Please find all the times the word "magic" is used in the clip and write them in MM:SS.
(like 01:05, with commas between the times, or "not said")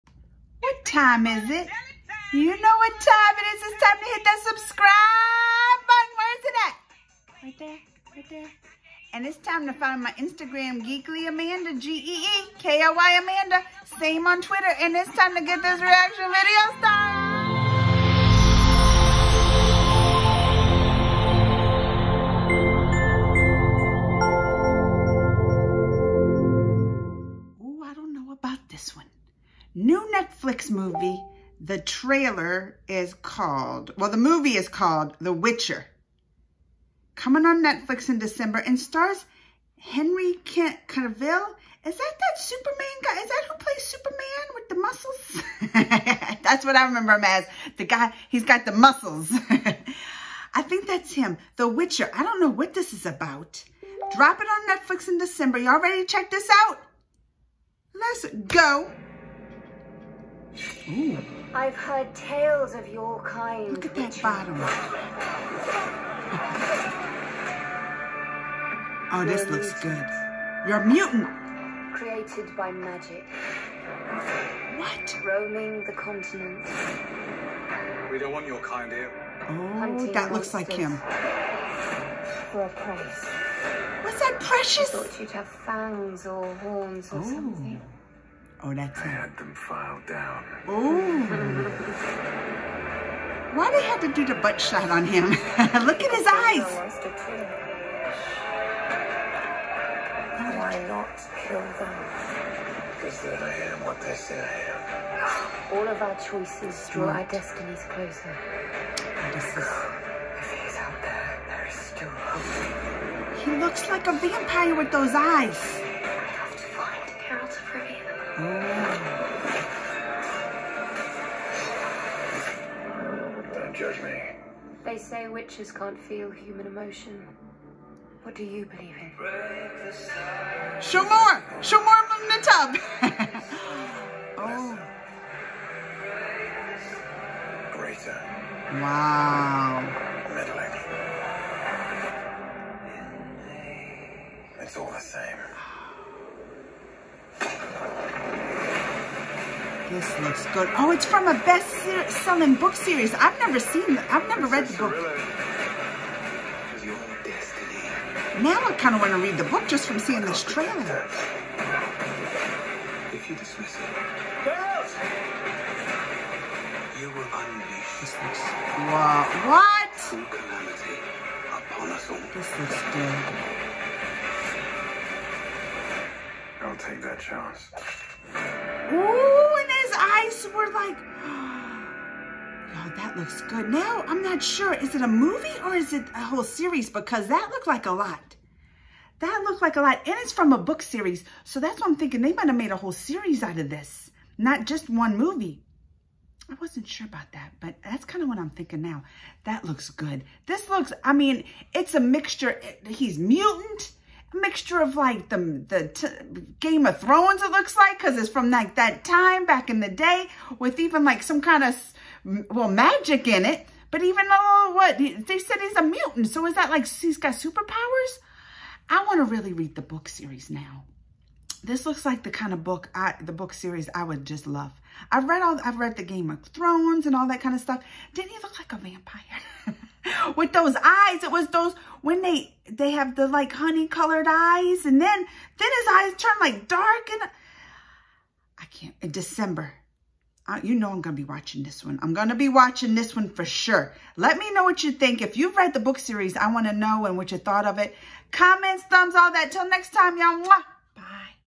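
01:12, 03:32.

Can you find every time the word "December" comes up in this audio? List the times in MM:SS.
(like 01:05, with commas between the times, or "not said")
00:38, 00:55, 03:59.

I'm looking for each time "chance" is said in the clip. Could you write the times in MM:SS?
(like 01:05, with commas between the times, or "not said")
02:57.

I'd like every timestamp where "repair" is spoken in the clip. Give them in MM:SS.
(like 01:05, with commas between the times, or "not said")
not said.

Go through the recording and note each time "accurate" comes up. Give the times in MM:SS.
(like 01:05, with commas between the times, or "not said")
not said.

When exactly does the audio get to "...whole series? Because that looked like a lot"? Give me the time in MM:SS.
03:06.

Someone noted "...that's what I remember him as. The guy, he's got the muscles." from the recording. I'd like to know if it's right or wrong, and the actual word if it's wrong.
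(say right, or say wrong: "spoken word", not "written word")
right.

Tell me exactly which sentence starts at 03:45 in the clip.
I've read all I've read the Game of Thrones and all that kind of stuff.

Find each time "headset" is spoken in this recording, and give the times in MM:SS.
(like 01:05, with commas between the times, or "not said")
not said.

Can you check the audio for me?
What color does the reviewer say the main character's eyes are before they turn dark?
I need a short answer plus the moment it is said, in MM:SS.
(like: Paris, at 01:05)
Honey, at 03:53.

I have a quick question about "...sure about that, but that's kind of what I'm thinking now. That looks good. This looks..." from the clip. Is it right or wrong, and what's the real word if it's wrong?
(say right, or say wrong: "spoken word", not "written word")
right.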